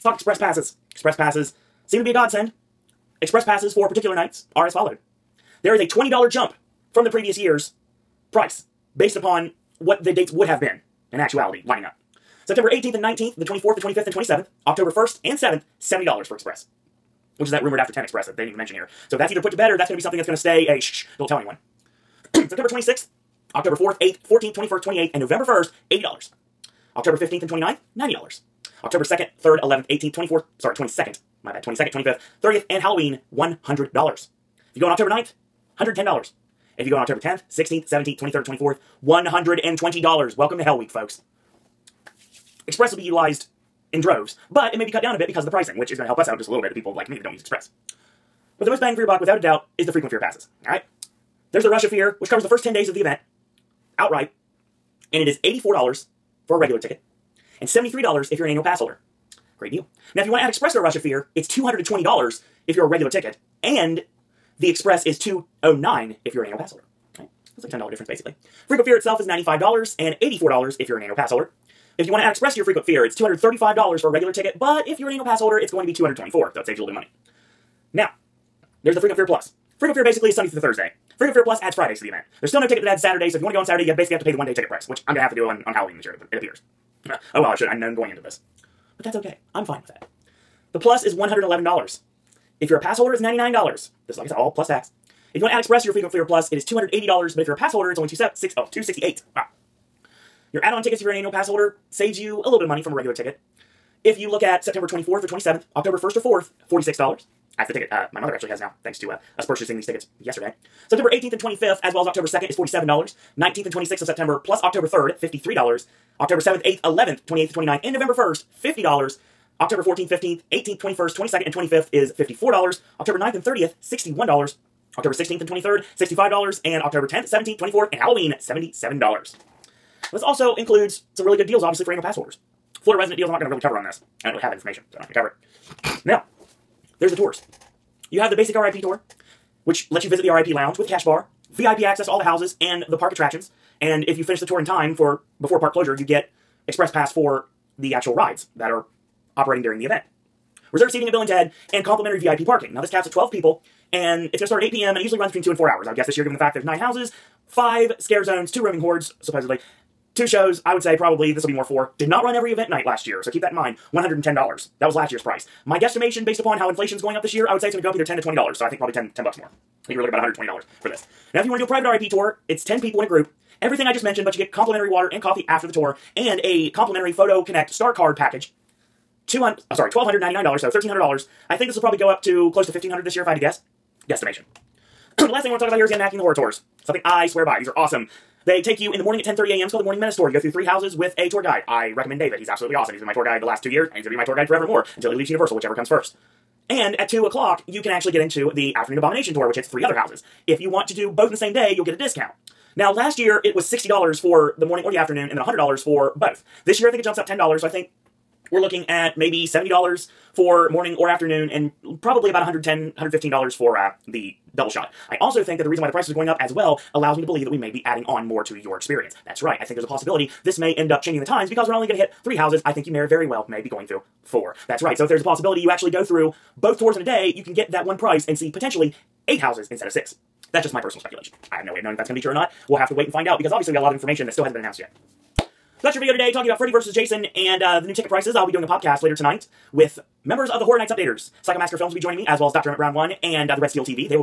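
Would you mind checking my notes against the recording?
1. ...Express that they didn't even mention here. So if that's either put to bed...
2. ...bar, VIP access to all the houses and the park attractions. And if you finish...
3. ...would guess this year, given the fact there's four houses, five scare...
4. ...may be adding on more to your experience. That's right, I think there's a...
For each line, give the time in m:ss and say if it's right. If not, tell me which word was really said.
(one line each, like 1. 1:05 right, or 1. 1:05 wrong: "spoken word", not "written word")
1. 0:18 right
2. 2:21 right
3. 2:35 wrong: "nine", not "four"
4. 3:37 right.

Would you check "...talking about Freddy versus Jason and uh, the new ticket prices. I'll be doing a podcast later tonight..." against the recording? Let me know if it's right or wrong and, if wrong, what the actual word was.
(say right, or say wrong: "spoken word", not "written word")
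right.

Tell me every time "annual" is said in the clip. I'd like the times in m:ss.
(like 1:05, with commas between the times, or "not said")
0:58, 1:06, 1:11, 1:15, 1:41, 2:11.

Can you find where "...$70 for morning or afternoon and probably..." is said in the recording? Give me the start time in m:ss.
3:29.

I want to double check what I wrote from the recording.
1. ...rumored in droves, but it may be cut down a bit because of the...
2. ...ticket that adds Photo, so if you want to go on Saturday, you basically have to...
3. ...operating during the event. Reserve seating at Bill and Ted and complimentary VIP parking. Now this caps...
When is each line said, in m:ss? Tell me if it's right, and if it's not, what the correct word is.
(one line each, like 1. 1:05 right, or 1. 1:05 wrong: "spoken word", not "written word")
1. 0:43 wrong: "utilized", not "rumored"
2. 1:22 wrong: "Saturday", not "Photo"
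3. 2:29 right.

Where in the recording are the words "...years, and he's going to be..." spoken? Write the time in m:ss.
3:13.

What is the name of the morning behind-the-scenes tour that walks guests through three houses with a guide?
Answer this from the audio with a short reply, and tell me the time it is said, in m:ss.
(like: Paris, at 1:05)
Morning Menace Tour, at 3:09.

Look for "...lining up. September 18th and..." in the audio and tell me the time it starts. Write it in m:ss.
0:11.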